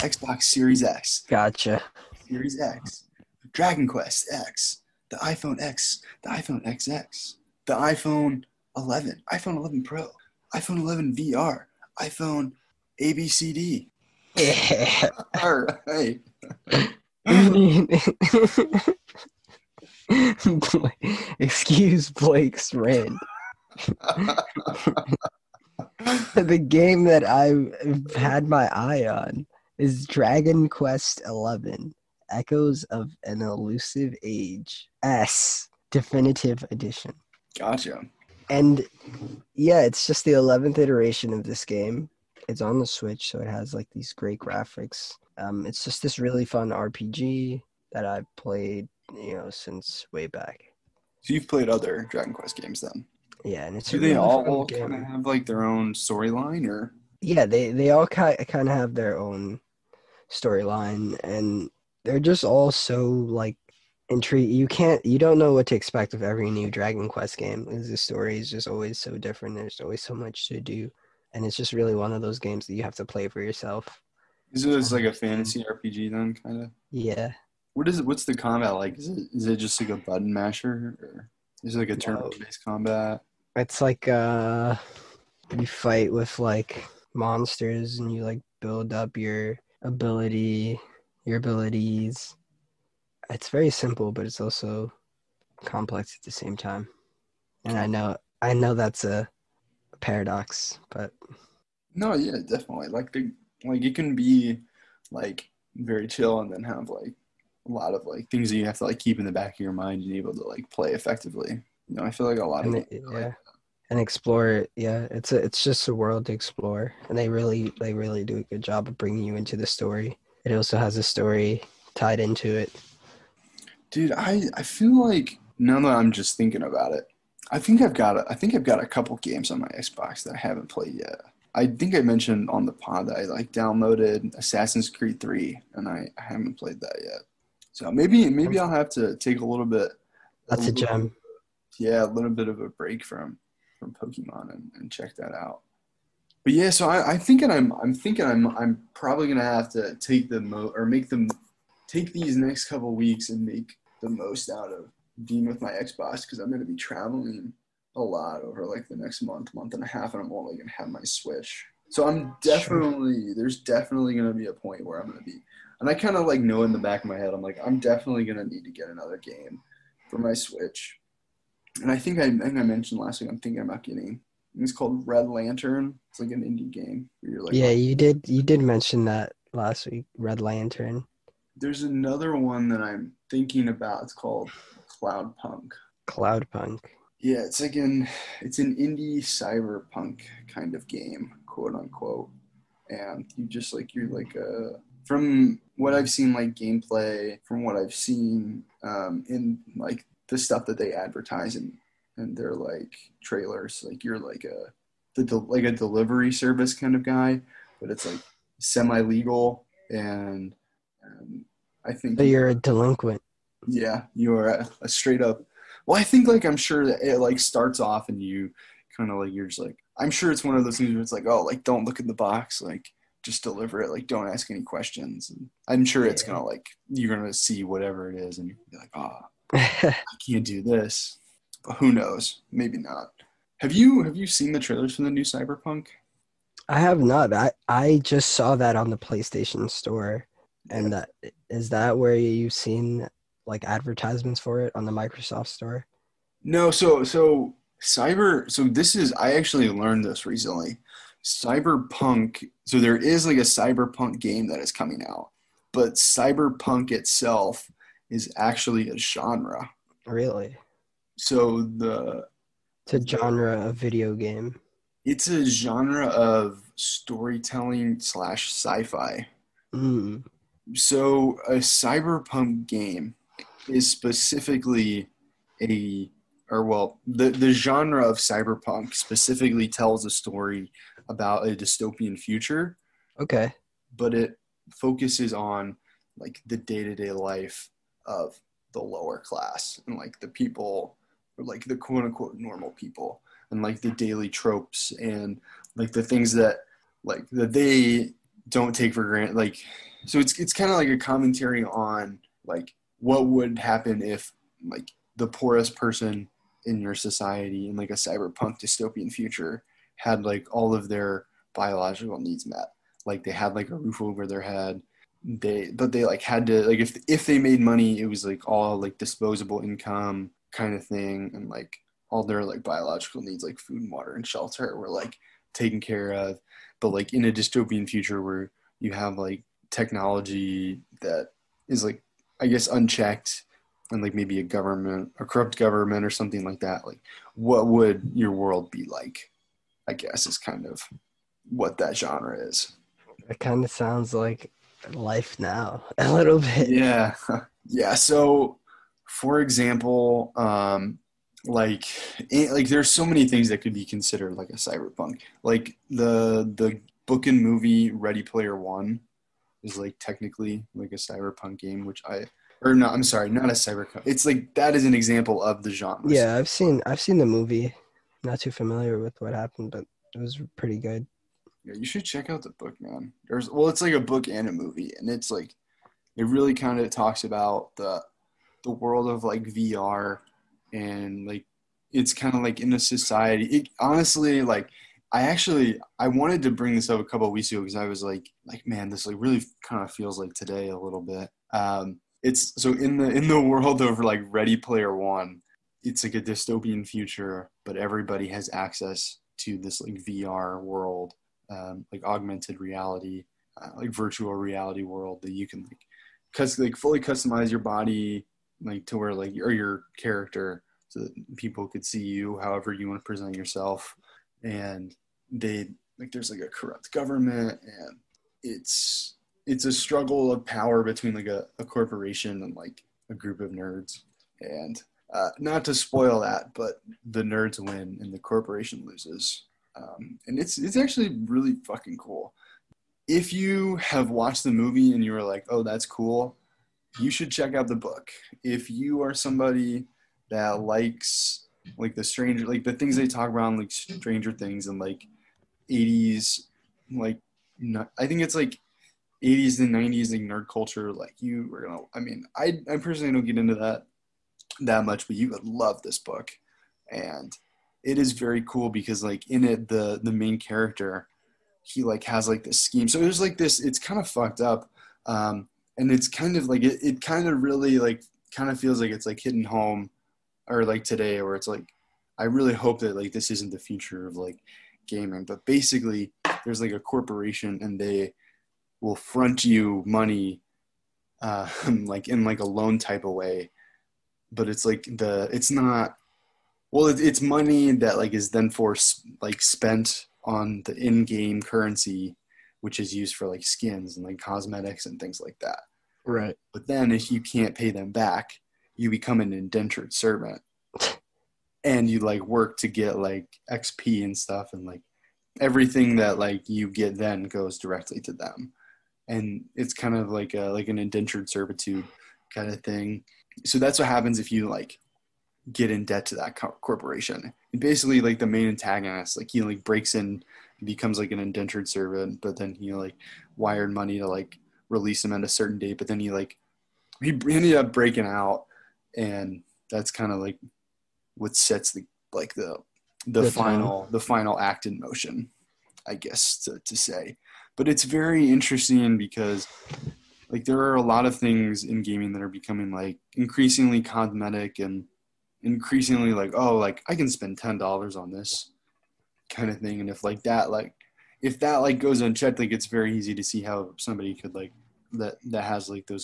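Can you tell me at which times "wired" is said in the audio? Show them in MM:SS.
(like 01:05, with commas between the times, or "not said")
08:43.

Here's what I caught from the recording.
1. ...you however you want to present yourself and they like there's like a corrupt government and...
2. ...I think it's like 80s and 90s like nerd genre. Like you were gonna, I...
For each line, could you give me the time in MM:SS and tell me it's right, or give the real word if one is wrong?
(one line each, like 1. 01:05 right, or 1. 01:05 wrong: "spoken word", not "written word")
1. 06:52 right
2. 07:27 wrong: "culture", not "genre".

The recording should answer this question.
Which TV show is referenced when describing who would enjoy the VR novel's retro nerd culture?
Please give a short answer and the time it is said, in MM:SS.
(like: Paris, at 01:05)
Stranger Things, at 07:23.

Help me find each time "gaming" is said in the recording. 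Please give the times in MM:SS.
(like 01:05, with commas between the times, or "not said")
07:54, 09:01.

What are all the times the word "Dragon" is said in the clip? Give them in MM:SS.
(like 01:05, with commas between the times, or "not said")
00:03, 00:30, 00:52, 01:06.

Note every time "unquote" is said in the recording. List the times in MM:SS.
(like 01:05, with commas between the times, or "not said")
03:11, 04:52.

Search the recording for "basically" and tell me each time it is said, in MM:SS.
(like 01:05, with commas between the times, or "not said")
07:55, 08:37.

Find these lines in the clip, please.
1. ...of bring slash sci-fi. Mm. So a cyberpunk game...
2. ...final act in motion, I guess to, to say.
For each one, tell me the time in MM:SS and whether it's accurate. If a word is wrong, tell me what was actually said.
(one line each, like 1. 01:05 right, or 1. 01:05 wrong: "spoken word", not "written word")
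1. 04:26 wrong: "storytelling", not "bring"
2. 08:53 right.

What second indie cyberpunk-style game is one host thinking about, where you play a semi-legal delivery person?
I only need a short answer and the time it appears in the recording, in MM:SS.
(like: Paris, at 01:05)
Cloudpunk, at 03:05.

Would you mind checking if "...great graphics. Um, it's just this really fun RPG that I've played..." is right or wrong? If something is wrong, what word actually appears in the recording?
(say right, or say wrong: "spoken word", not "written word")
right.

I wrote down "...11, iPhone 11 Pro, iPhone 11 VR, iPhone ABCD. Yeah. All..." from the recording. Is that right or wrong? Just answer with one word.
right.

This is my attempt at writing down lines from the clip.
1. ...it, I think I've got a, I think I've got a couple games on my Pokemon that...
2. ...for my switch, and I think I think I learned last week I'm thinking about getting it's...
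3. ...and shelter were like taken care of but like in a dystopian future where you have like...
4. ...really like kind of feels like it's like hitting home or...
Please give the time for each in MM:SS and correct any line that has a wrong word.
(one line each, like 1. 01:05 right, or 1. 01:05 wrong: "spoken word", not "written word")
1. 02:06 wrong: "Xbox", not "Pokemon"
2. 02:50 wrong: "mentioned", not "learned"
3. 05:24 right
4. 07:47 right.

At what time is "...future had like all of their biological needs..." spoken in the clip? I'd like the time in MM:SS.
05:09.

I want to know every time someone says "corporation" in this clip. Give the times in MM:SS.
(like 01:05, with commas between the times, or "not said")
07:01, 07:08, 07:56, 08:36.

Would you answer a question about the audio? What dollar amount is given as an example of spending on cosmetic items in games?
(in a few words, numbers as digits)
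$10.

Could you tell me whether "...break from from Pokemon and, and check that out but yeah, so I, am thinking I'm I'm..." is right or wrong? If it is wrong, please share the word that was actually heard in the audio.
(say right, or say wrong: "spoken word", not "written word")
right.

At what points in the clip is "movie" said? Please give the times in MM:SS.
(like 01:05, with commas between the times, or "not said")
05:57, 06:07, 06:14, 07:14.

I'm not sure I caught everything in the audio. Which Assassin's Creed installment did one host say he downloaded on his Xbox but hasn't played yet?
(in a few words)
Assassin's Creed 3.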